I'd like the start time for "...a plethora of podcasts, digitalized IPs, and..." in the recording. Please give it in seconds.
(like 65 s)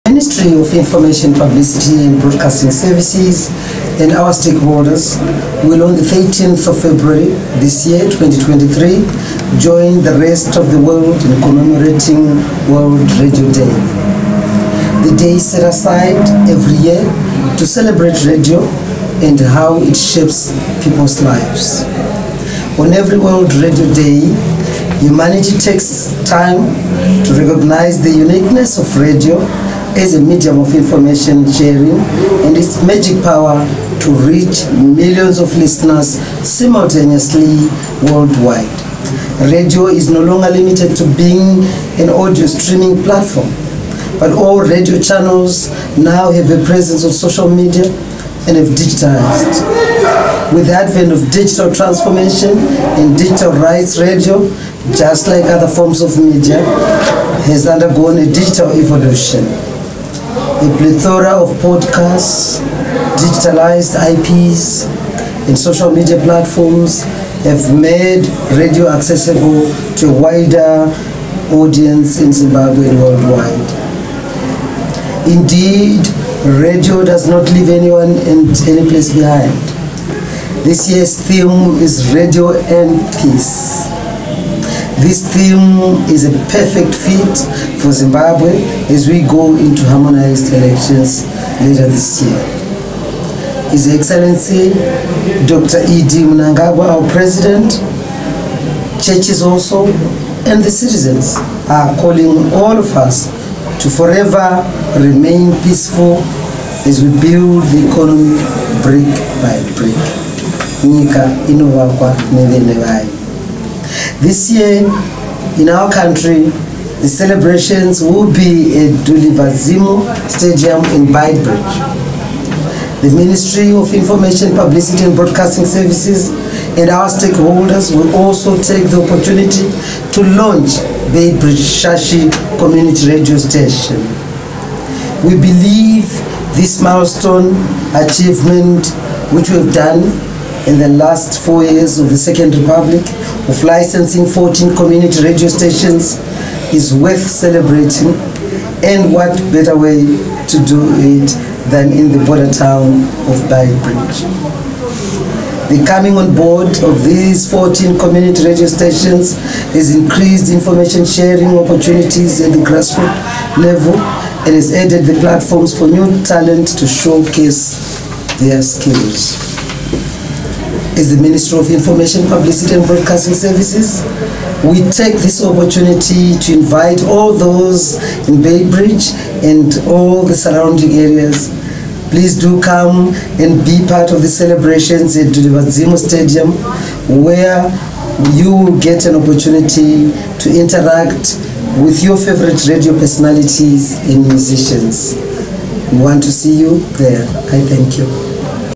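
60 s.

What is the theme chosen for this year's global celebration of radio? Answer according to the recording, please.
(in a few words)
Radio and Peace.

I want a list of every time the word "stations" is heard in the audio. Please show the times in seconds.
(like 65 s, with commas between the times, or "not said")
133 s, 145 s, 158 s.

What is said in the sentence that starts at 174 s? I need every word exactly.
We take this opportunity to invite all those in Beitbridge and all the surrounding areas.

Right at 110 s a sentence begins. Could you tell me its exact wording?
Nyika inovakwa nevene this year, in our country, the celebrations will be at Dulivhadzimu Stadium in Beitbridge.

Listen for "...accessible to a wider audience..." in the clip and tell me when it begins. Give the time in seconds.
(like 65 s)
68 s.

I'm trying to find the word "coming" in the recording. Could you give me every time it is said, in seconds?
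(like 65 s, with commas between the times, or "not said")
155 s.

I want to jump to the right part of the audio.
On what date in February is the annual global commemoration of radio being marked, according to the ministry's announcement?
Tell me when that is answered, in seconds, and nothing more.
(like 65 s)
6 s.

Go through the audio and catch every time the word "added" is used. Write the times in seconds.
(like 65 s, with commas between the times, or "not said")
164 s.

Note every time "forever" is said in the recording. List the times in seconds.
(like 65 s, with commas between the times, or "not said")
103 s.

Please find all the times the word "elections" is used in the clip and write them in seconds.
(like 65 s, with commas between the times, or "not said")
90 s.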